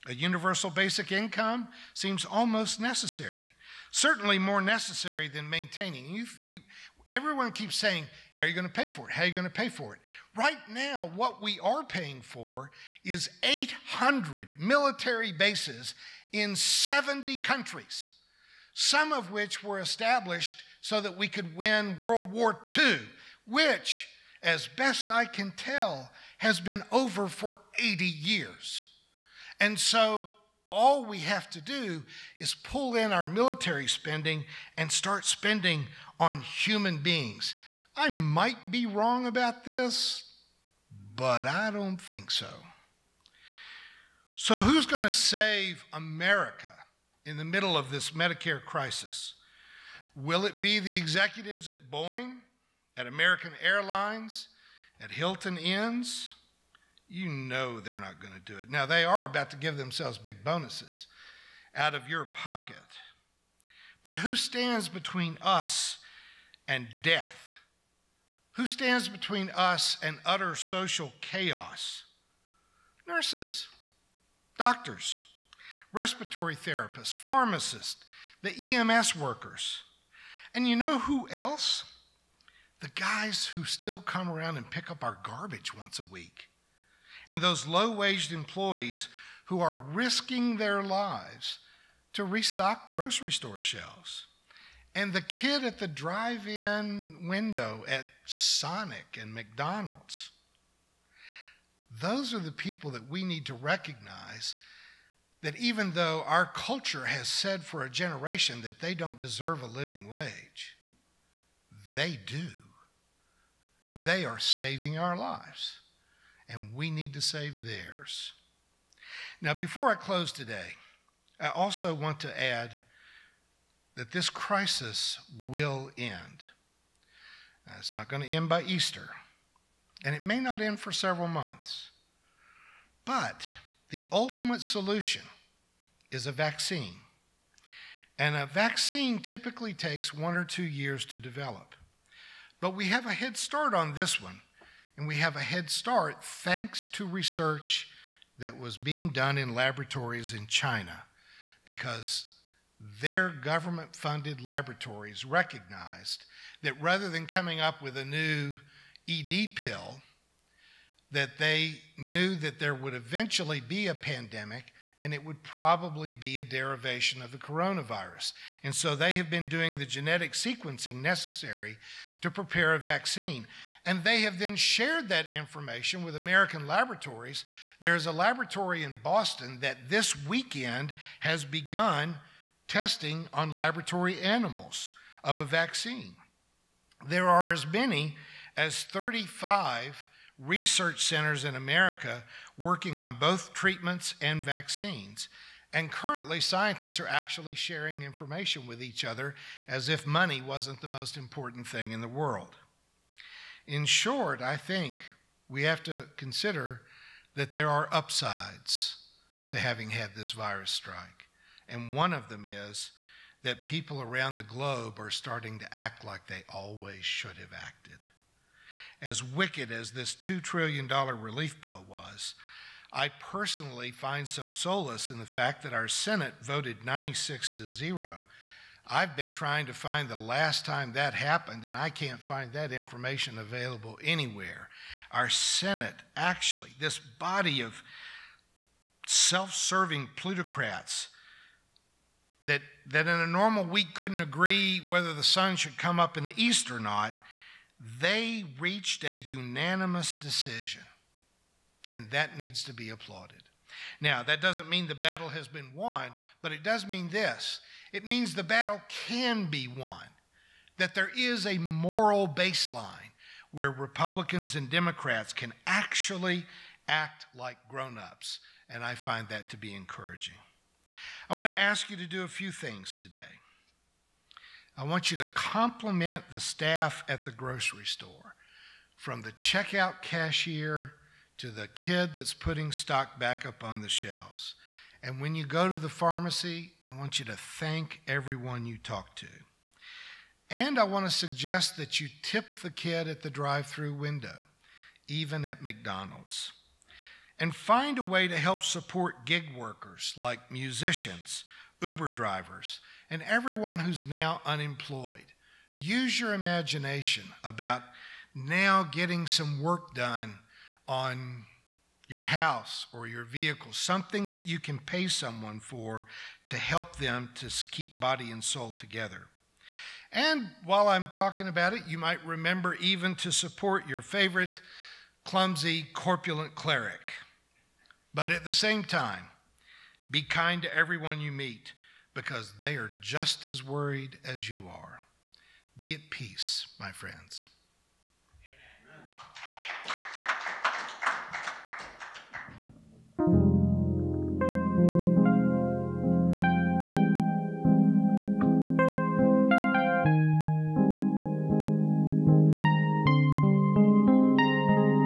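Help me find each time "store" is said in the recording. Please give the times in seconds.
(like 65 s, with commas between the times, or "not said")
93 s, 277 s.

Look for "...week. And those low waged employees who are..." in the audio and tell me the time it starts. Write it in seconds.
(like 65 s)
86 s.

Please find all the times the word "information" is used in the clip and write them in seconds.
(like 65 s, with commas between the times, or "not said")
175 s, 198 s, 232 s.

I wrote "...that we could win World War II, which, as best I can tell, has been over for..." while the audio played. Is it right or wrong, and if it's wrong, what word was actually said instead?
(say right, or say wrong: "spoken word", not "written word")
right.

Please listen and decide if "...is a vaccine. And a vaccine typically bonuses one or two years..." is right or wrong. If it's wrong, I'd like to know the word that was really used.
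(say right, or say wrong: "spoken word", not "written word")
wrong: "takes", not "bonuses".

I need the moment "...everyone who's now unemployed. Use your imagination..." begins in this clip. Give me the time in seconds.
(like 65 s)
303 s.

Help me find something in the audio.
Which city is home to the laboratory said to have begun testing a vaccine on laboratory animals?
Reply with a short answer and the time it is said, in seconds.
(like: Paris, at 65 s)
Boston, at 179 s.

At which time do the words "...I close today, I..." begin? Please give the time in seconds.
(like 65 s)
119 s.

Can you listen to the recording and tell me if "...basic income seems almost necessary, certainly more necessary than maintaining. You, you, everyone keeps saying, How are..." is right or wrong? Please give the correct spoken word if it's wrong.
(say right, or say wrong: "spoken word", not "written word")
right.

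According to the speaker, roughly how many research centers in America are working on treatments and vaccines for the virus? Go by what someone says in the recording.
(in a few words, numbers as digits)
35.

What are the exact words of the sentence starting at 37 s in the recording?
I might be wrong about this but I don't think so.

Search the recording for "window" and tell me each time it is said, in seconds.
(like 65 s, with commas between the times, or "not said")
97 s, 293 s.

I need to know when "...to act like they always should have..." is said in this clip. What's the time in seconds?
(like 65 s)
215 s.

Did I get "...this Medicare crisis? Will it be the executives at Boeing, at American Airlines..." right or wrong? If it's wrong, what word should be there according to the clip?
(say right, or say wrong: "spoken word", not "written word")
right.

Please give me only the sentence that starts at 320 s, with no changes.
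And while I'm talking about it, you might remember even to support your favorite clumsy, corpulent cleric.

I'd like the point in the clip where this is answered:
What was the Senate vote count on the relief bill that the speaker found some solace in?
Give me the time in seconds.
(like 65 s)
226 s.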